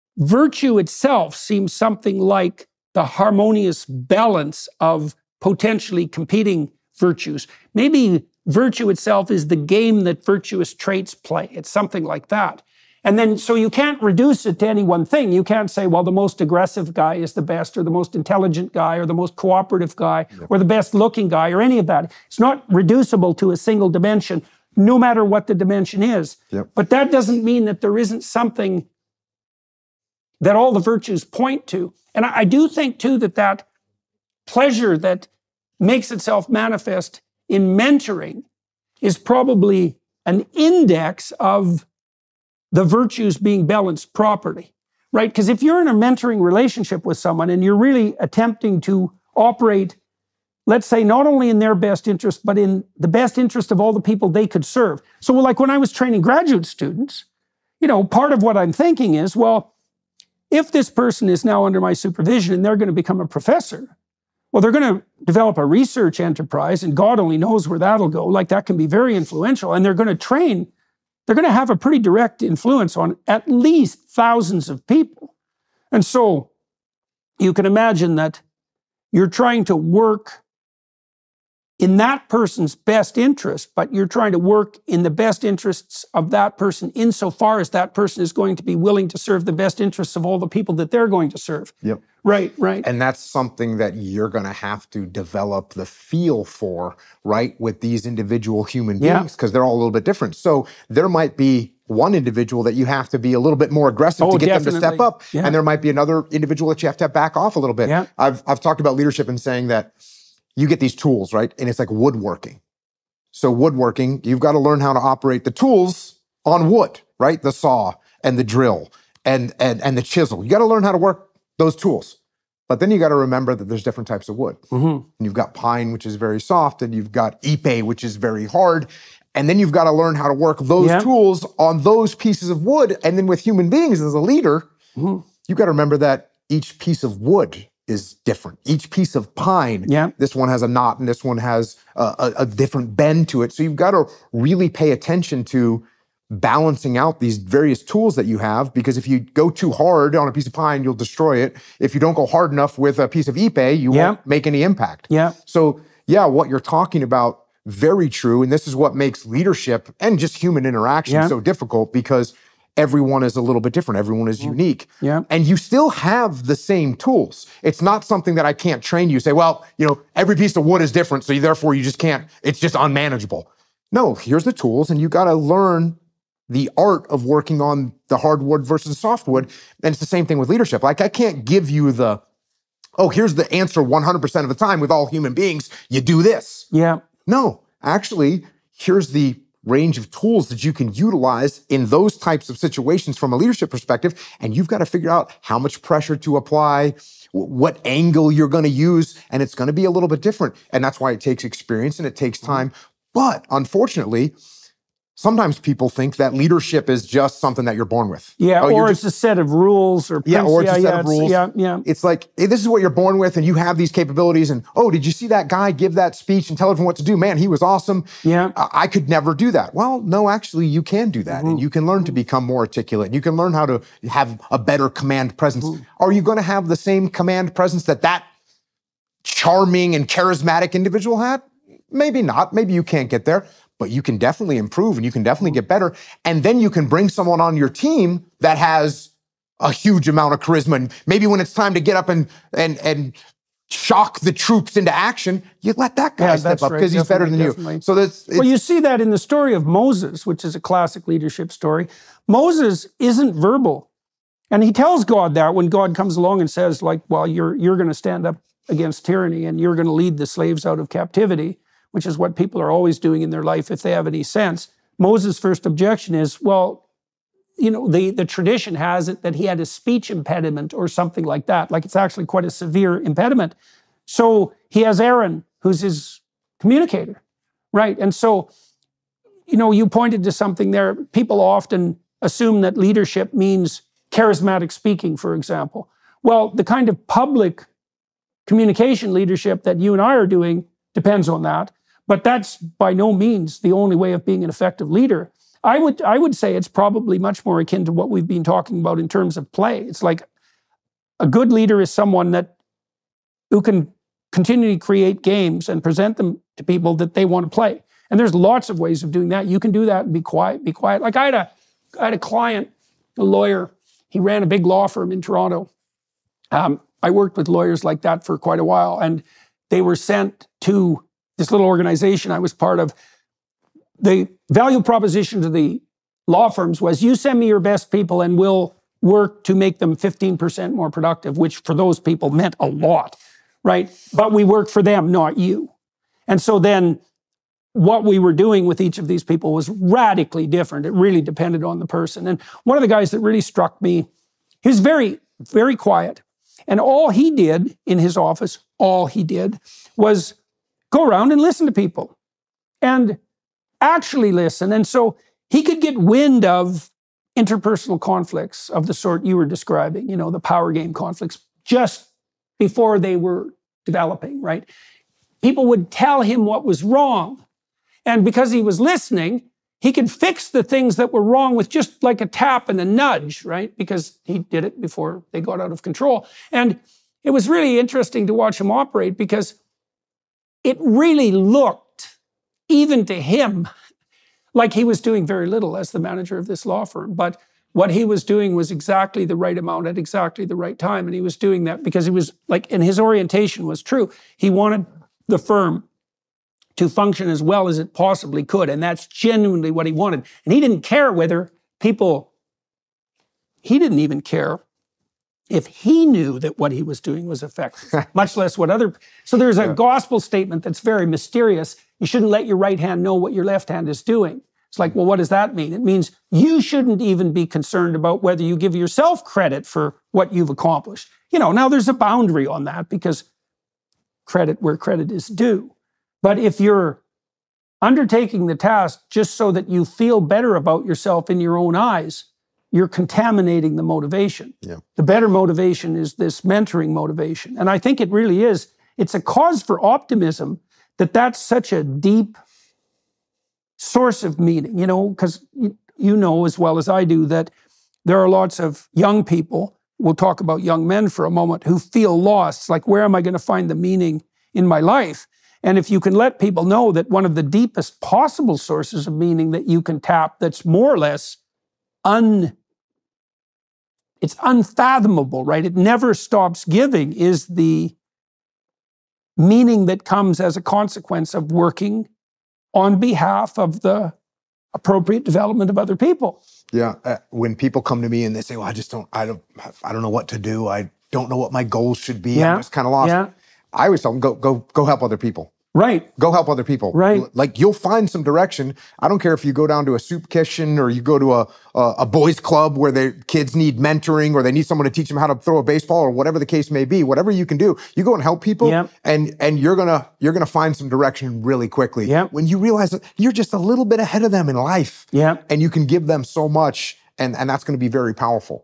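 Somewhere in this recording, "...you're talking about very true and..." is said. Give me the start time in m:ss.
2:36.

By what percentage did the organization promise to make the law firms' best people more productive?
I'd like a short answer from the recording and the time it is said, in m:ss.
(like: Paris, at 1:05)
15%, at 5:29.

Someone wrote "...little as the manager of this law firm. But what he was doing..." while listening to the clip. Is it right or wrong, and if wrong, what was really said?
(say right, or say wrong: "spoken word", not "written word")
right.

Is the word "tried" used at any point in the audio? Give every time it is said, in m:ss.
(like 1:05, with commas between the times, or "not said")
not said.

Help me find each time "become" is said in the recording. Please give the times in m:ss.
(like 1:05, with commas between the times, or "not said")
1:02, 3:42.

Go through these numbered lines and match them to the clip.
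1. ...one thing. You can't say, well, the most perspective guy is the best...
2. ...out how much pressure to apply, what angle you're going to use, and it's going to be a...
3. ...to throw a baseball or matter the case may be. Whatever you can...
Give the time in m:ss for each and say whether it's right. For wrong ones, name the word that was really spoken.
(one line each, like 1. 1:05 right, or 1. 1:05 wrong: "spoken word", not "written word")
1. 0:14 wrong: "aggressive", not "perspective"
2. 3:15 right
3. 8:15 wrong: "whatever", not "matter".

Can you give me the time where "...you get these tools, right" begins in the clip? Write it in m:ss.
1:50.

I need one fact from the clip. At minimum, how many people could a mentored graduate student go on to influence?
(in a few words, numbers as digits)
thousands.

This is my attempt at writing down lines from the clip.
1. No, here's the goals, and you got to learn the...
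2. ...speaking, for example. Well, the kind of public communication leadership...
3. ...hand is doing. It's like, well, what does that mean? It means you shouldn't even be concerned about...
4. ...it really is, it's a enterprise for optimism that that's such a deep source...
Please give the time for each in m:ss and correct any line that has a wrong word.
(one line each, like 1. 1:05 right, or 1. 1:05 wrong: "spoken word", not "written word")
1. 2:53 wrong: "tools", not "goals"
2. 4:44 right
3. 6:53 right
4. 7:17 wrong: "cause", not "enterprise".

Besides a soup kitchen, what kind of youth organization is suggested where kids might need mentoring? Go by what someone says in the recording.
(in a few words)
boys club.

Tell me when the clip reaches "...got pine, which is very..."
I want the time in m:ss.
2:05.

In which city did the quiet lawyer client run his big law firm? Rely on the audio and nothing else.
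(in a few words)
Toronto.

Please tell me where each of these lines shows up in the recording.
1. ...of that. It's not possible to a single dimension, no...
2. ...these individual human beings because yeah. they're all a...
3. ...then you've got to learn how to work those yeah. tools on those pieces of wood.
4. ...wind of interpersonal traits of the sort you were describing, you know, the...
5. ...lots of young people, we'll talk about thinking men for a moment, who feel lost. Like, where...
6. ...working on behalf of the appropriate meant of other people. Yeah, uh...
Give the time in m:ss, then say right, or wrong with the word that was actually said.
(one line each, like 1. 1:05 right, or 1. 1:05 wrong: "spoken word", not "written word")
1. 0:21 wrong: "reducible", not "possible"
2. 1:37 right
3. 2:09 right
4. 5:55 wrong: "conflicts", not "traits"
5. 7:28 wrong: "young", not "thinking"
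6. 7:51 wrong: "development", not "meant".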